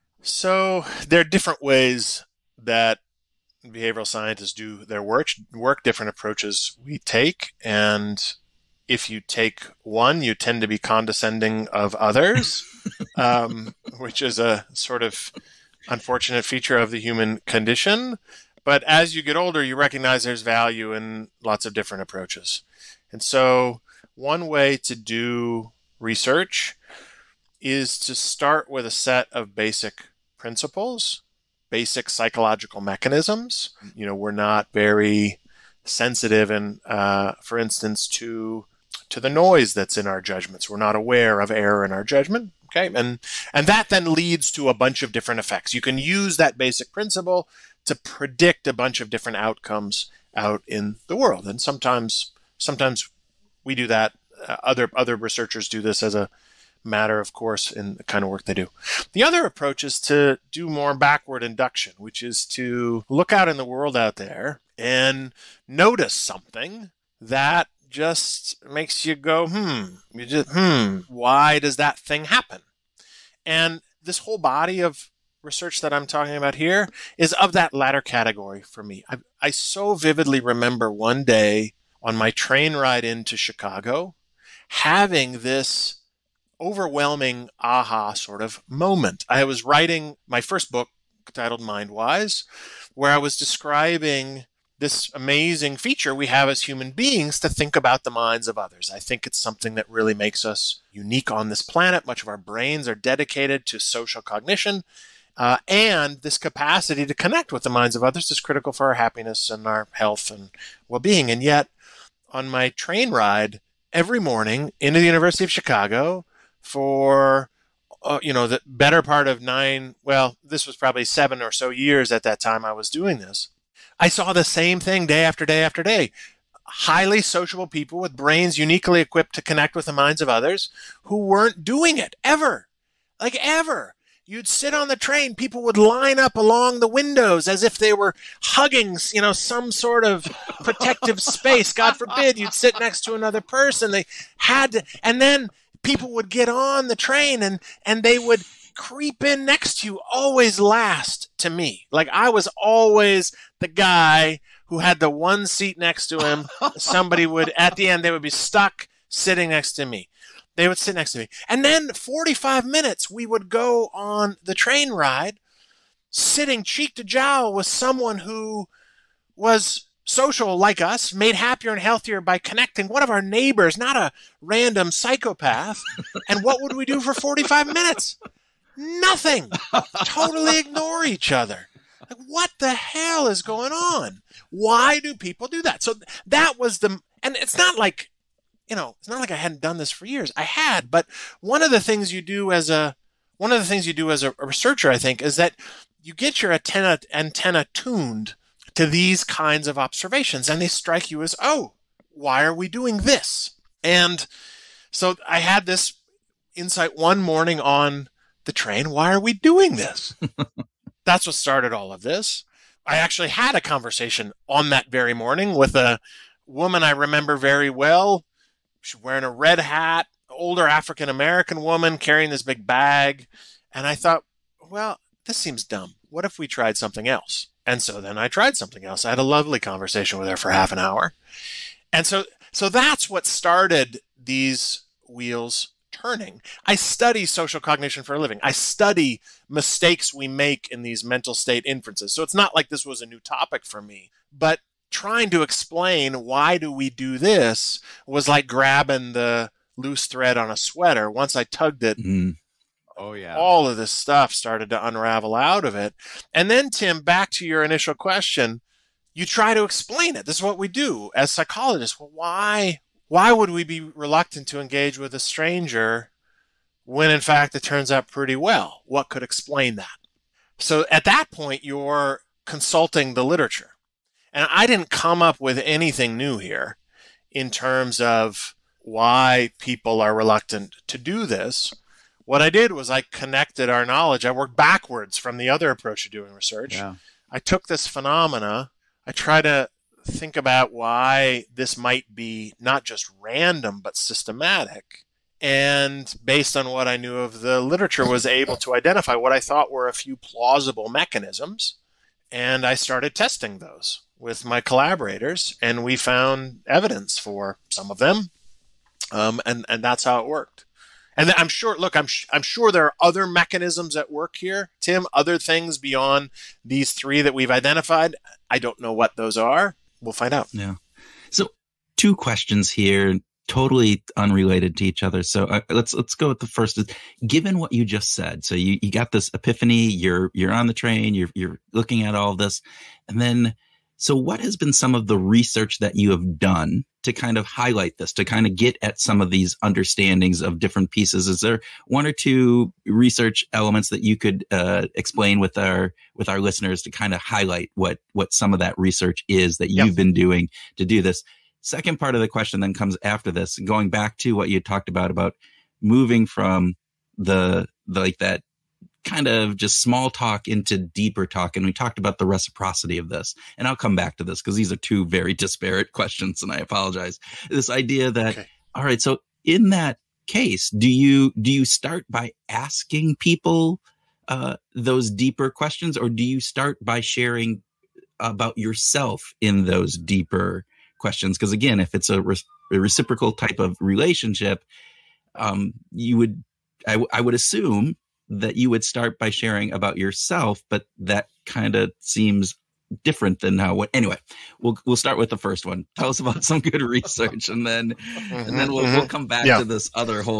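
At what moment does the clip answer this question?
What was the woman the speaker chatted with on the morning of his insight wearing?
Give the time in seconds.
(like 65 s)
219 s.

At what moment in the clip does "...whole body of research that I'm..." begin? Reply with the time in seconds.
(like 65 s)
74 s.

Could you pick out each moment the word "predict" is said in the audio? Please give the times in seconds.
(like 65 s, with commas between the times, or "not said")
47 s.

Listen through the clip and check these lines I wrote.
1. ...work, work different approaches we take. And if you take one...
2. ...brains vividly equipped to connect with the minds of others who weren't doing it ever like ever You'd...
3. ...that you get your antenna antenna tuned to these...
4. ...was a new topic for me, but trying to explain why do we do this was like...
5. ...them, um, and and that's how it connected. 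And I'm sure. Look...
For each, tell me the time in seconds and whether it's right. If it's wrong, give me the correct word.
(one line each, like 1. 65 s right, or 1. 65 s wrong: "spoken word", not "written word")
1. 5 s right
2. 128 s wrong: "uniquely", not "vividly"
3. 195 s right
4. 242 s right
5. 307 s wrong: "worked", not "connected".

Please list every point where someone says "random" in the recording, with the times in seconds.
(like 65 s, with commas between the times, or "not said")
174 s, 293 s.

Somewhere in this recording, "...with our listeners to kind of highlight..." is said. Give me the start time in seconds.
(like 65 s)
346 s.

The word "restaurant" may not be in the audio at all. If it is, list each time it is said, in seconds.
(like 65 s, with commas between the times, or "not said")
not said.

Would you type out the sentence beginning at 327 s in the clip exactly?
Given what you just said, so you, you got this epiphany.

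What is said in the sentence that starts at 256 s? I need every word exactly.
And then Tim, back to your initial question, you try to explain it.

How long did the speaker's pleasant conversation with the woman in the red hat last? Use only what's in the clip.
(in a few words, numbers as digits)
Half an hour.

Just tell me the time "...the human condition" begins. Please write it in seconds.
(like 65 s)
16 s.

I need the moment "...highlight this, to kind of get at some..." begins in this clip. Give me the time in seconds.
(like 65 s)
337 s.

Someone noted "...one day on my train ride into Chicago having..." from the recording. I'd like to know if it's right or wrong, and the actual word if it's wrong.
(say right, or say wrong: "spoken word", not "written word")
right.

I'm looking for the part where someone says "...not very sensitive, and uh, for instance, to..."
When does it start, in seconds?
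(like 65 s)
34 s.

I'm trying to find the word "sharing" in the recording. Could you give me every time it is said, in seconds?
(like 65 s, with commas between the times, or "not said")
376 s, 389 s.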